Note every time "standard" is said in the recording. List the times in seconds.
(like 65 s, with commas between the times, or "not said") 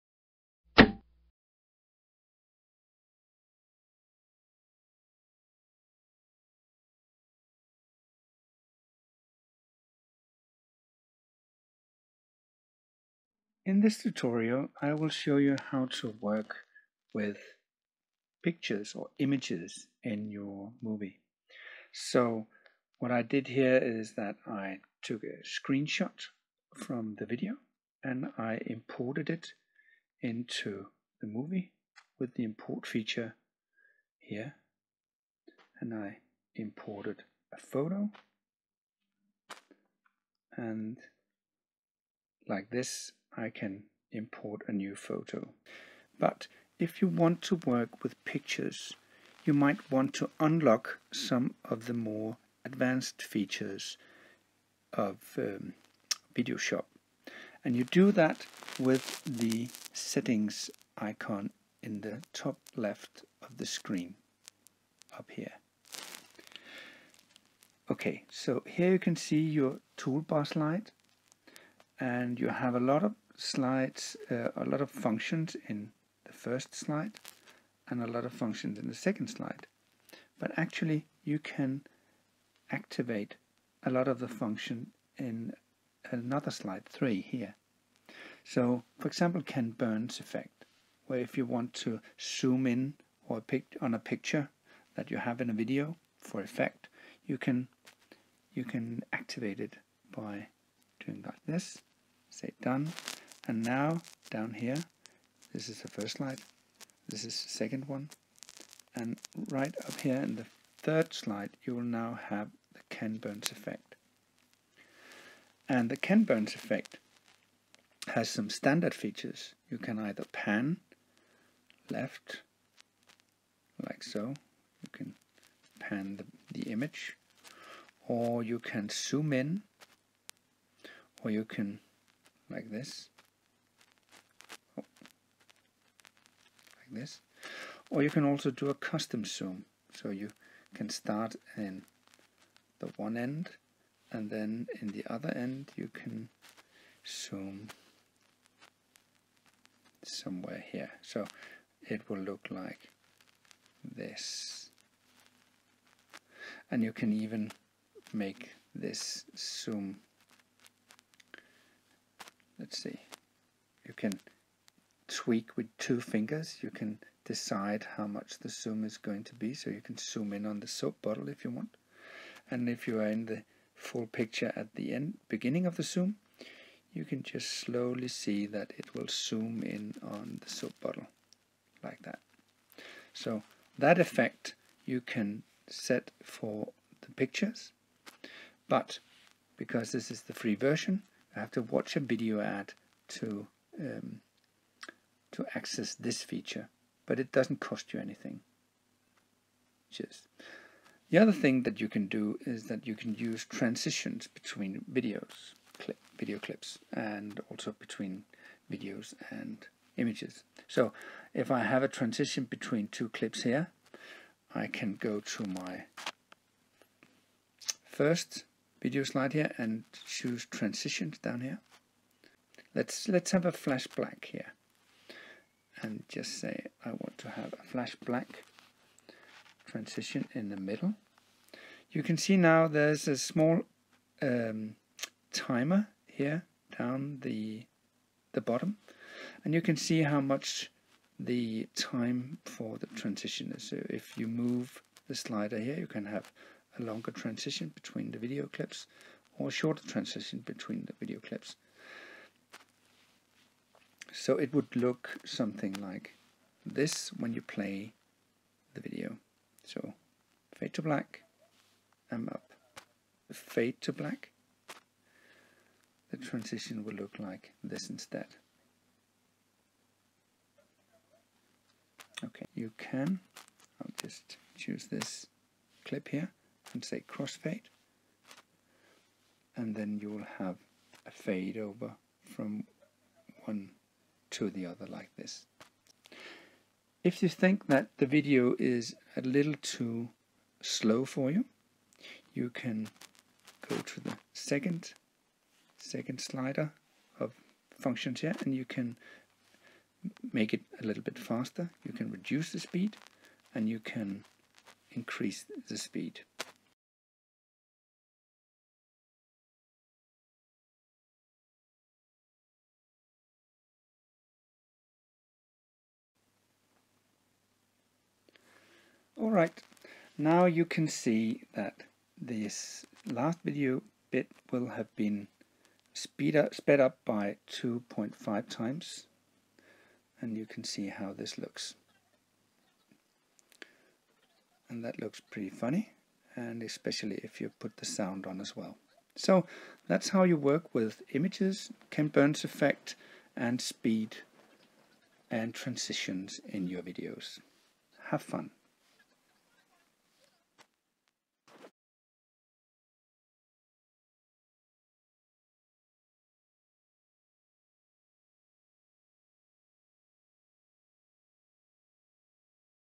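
118 s.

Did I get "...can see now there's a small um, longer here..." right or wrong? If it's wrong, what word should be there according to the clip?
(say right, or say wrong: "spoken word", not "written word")
wrong: "timer", not "longer".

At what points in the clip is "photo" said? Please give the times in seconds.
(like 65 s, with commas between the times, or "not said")
37 s, 44 s.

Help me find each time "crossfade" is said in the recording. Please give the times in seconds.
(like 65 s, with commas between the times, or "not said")
277 s.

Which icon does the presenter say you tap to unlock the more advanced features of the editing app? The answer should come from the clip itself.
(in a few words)
Settings icon.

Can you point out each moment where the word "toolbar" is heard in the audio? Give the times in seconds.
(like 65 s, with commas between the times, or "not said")
69 s.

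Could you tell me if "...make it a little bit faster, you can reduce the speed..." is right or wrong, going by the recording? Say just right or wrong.
right.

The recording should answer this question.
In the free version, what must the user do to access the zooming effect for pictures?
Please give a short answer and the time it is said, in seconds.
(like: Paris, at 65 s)
Watch a video ad, at 191 s.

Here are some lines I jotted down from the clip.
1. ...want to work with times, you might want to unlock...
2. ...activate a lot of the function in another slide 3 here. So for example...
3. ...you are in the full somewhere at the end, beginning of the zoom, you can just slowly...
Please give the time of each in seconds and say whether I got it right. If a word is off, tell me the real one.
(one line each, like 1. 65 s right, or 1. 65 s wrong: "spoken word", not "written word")
1. 47 s wrong: "pictures", not "times"
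2. 82 s right
3. 172 s wrong: "picture", not "somewhere".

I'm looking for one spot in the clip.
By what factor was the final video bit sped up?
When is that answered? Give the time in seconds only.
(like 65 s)
327 s.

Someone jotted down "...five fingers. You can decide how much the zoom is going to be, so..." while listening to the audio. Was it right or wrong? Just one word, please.
wrong.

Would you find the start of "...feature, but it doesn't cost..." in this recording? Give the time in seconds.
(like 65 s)
196 s.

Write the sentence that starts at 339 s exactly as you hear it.
So that's how you work with images, Ken Burns effect and speed and transitions in your videos.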